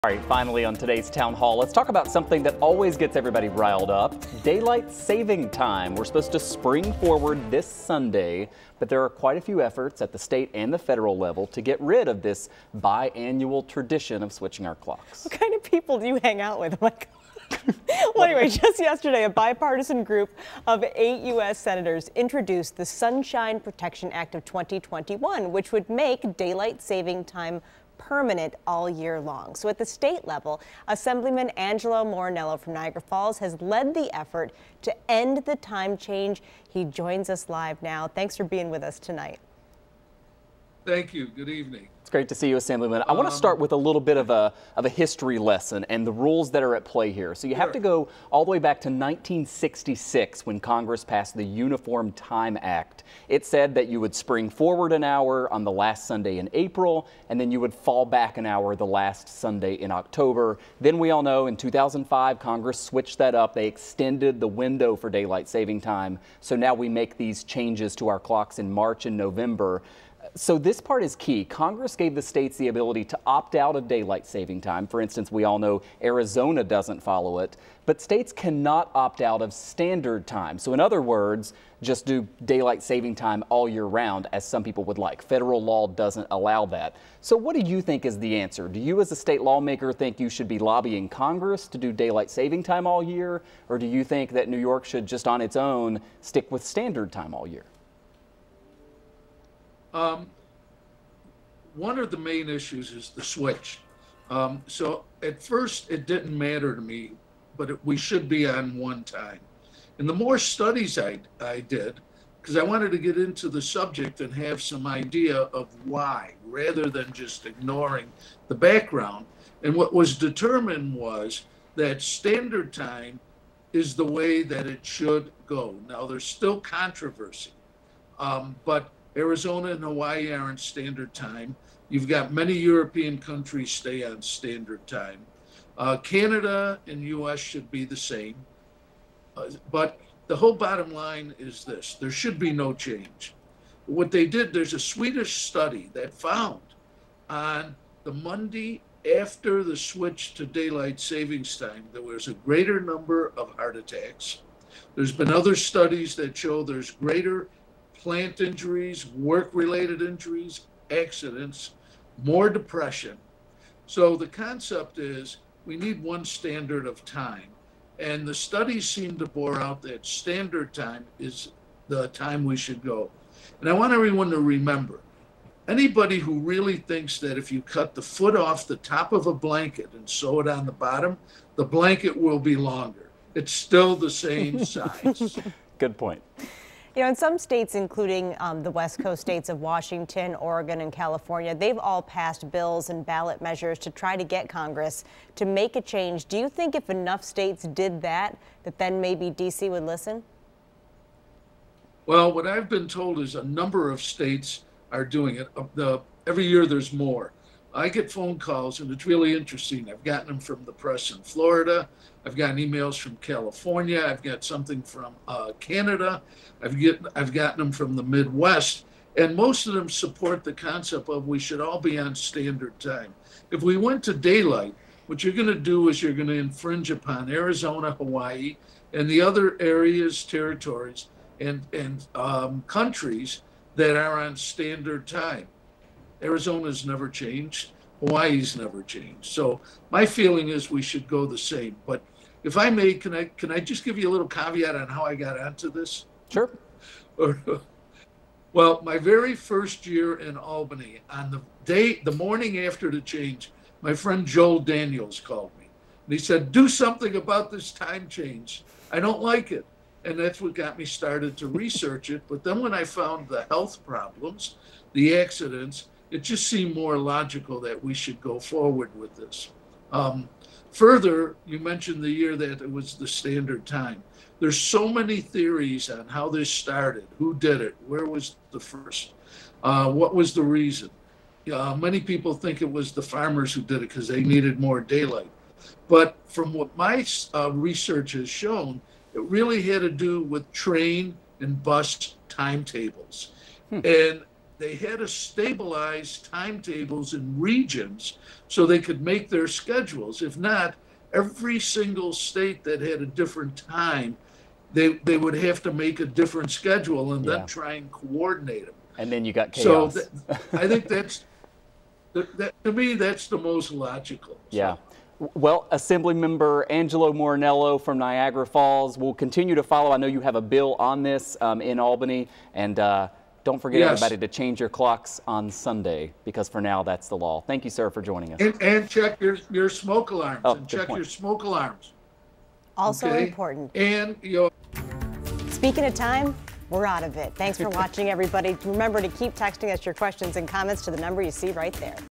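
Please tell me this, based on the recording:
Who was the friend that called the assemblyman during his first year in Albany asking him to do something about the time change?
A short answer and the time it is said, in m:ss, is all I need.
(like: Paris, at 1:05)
Joel Daniels, at 4:14.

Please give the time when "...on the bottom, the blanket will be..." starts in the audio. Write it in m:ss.
3:00.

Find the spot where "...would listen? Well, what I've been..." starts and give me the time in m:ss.
3:19.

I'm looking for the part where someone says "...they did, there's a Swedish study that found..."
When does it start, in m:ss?
2:24.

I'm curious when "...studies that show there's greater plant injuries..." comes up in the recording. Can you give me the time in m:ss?
2:35.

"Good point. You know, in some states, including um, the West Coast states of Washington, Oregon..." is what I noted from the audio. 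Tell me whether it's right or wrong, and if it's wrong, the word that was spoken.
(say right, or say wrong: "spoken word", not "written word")
right.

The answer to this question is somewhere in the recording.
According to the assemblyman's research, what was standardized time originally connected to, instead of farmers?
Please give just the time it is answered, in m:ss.
4:50.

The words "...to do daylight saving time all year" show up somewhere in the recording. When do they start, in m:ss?
1:31.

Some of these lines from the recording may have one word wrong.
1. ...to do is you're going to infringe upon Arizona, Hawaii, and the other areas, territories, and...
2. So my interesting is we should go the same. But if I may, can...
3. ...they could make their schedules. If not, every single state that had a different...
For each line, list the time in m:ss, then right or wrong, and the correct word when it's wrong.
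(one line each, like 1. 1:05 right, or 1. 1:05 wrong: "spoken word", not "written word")
1. 3:45 right
2. 3:59 wrong: "feeling", not "interesting"
3. 4:58 right.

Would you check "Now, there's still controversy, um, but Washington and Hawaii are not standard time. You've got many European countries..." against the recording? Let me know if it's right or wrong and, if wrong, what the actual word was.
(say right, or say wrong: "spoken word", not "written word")
wrong: "Arizona", not "Washington".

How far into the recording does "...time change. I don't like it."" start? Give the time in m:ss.
4:17.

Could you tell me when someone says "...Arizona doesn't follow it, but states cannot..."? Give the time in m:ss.
1:16.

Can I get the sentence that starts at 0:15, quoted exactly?
What kind of people do you hang out with?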